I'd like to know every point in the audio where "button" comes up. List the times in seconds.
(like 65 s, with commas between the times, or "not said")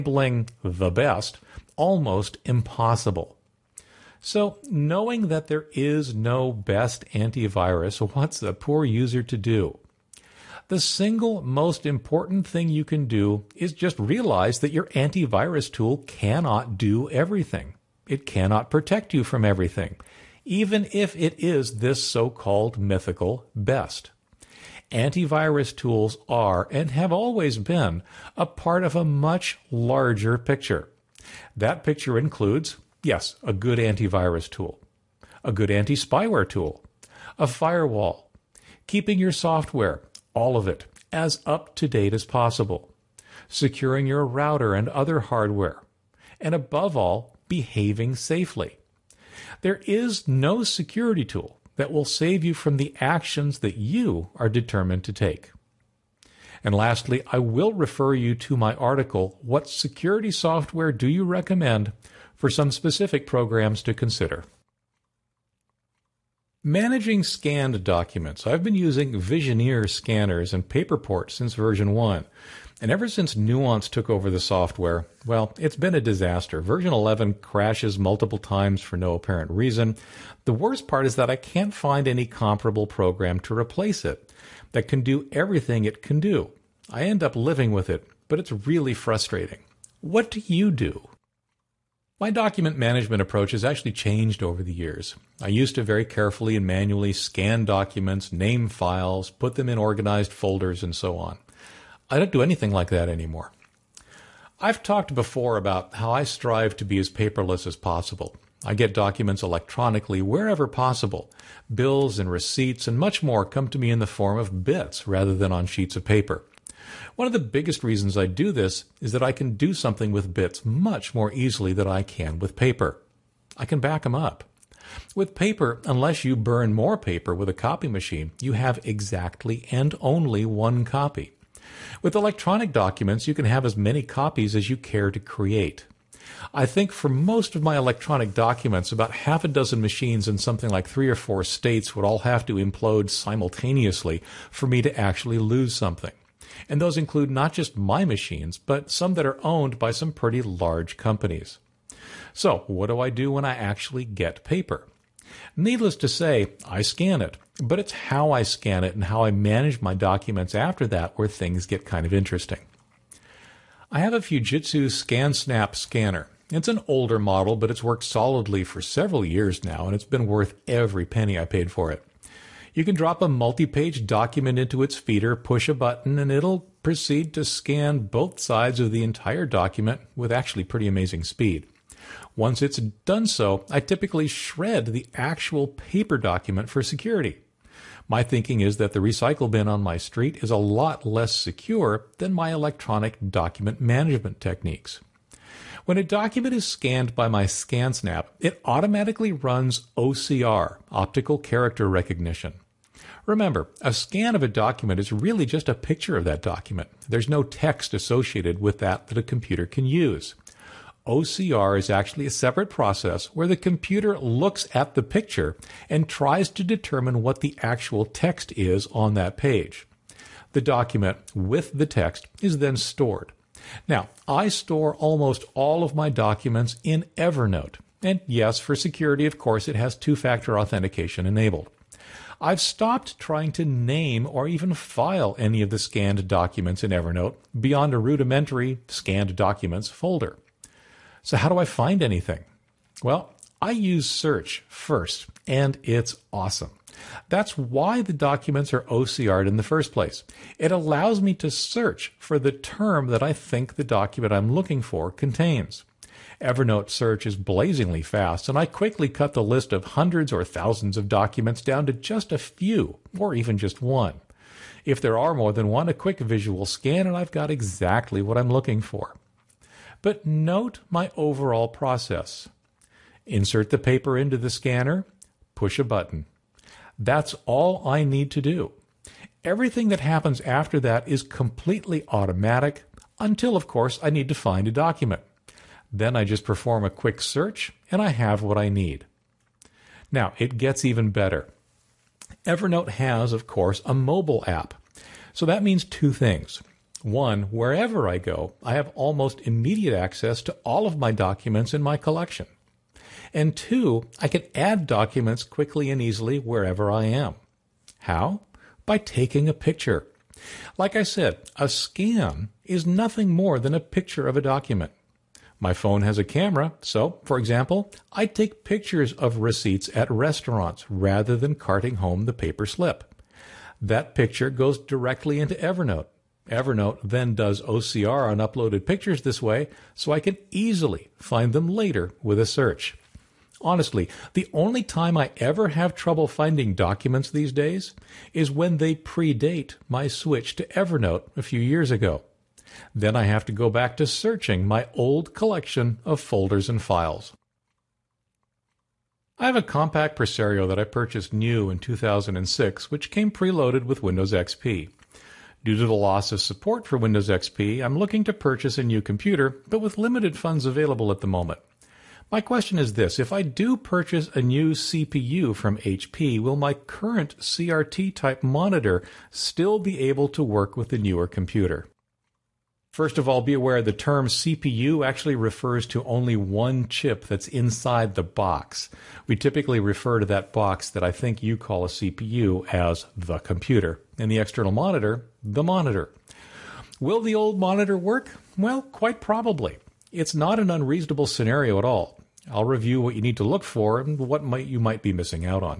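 175 s, 275 s.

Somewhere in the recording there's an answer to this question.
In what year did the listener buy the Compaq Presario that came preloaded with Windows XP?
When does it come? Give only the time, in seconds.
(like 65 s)
351 s.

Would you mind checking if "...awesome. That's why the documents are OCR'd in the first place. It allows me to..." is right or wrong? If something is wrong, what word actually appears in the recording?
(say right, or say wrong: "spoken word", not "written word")
right.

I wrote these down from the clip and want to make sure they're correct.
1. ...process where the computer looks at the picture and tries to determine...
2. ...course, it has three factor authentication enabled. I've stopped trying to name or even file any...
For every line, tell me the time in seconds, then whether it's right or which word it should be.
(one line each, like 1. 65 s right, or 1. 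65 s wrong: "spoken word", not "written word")
1. 212 s right
2. 229 s wrong: "two", not "three".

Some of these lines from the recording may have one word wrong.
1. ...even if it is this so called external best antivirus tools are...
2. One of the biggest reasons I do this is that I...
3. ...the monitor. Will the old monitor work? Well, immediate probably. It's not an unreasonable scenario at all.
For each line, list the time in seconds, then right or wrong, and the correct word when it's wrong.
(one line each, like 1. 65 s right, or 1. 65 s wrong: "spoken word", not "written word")
1. 20 s wrong: "mythical", not "external"
2. 117 s right
3. 385 s wrong: "quite", not "immediate".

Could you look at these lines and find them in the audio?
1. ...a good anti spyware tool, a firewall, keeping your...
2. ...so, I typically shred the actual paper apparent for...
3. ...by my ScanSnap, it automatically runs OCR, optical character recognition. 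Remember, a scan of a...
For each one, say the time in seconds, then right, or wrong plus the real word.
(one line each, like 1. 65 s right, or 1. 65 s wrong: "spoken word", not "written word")
1. 35 s right
2. 183 s wrong: "document", not "apparent"
3. 197 s right.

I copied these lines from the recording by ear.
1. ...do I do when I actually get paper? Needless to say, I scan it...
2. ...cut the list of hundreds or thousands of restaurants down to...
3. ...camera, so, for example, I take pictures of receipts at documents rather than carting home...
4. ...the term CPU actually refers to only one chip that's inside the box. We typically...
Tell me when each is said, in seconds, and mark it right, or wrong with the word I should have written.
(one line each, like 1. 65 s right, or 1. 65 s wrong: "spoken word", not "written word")
1. 152 s right
2. 259 s wrong: "documents", not "restaurants"
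3. 316 s wrong: "restaurants", not "documents"
4. 373 s right.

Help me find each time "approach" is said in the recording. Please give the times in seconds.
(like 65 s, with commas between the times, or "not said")
93 s.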